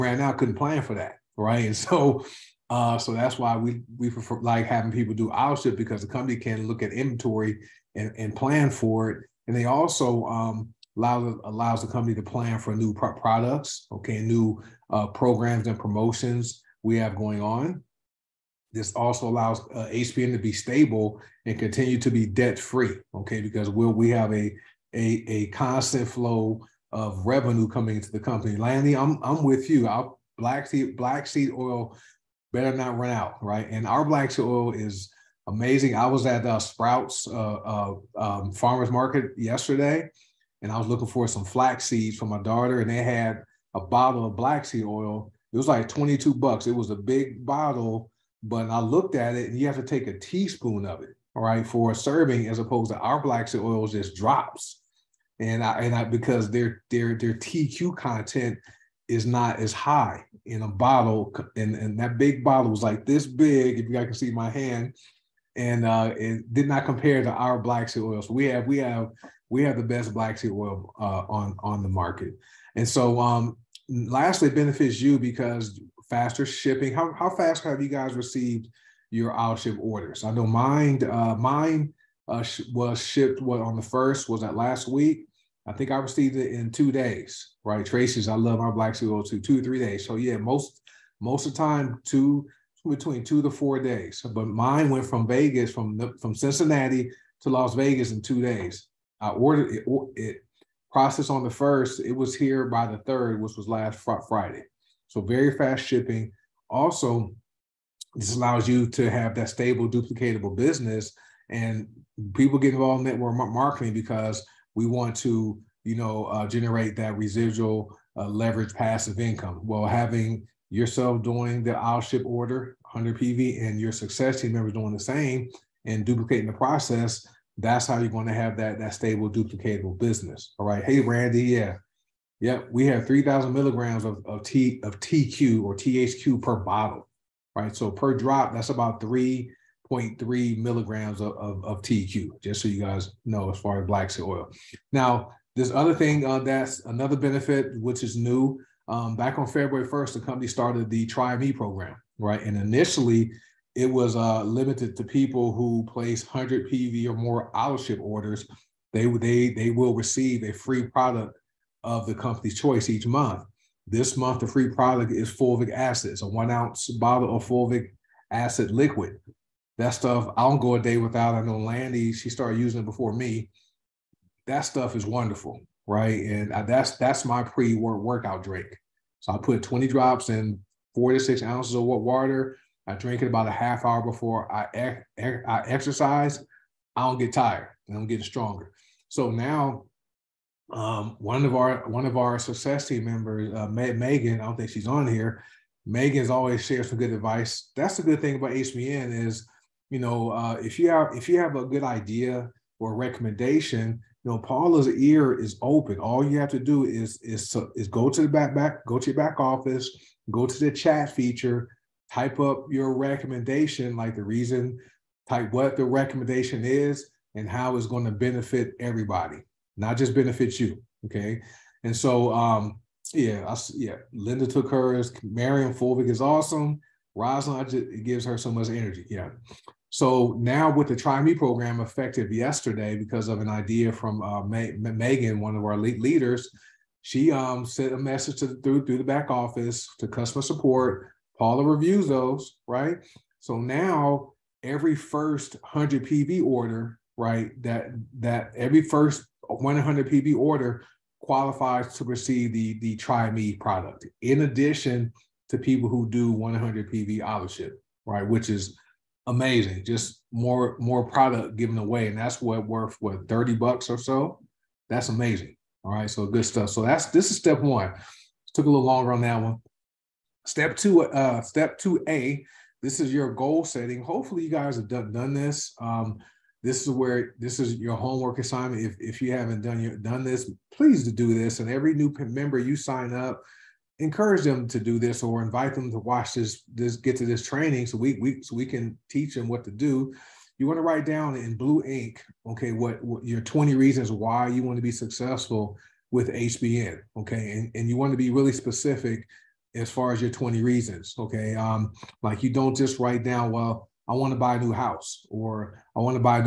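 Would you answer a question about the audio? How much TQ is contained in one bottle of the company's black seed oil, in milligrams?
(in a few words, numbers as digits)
3,000 milligrams.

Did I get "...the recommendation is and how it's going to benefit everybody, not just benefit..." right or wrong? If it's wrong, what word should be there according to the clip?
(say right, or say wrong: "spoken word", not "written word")
right.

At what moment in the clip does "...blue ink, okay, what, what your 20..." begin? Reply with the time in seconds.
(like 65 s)
291 s.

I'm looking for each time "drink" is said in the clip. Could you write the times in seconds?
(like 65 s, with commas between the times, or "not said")
178 s, 182 s.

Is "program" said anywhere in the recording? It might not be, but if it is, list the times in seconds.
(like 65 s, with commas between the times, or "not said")
15 s, 151 s, 231 s.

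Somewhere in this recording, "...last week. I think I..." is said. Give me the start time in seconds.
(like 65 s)
84 s.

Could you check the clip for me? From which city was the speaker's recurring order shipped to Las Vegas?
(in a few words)
Cincinnati.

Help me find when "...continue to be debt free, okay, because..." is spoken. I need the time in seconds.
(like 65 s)
21 s.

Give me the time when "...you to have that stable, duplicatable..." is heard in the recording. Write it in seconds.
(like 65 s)
108 s.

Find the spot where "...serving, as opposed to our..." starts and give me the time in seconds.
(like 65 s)
51 s.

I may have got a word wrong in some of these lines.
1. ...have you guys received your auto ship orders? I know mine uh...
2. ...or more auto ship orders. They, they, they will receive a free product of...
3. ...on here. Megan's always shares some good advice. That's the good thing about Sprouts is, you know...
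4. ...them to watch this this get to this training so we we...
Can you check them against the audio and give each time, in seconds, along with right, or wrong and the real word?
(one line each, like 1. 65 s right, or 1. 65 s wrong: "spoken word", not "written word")
1. 77 s right
2. 157 s right
3. 194 s wrong: "HBN", not "Sprouts"
4. 285 s right.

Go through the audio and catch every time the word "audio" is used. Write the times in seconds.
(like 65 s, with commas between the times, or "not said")
not said.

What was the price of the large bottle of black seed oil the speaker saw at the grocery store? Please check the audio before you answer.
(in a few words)
$22.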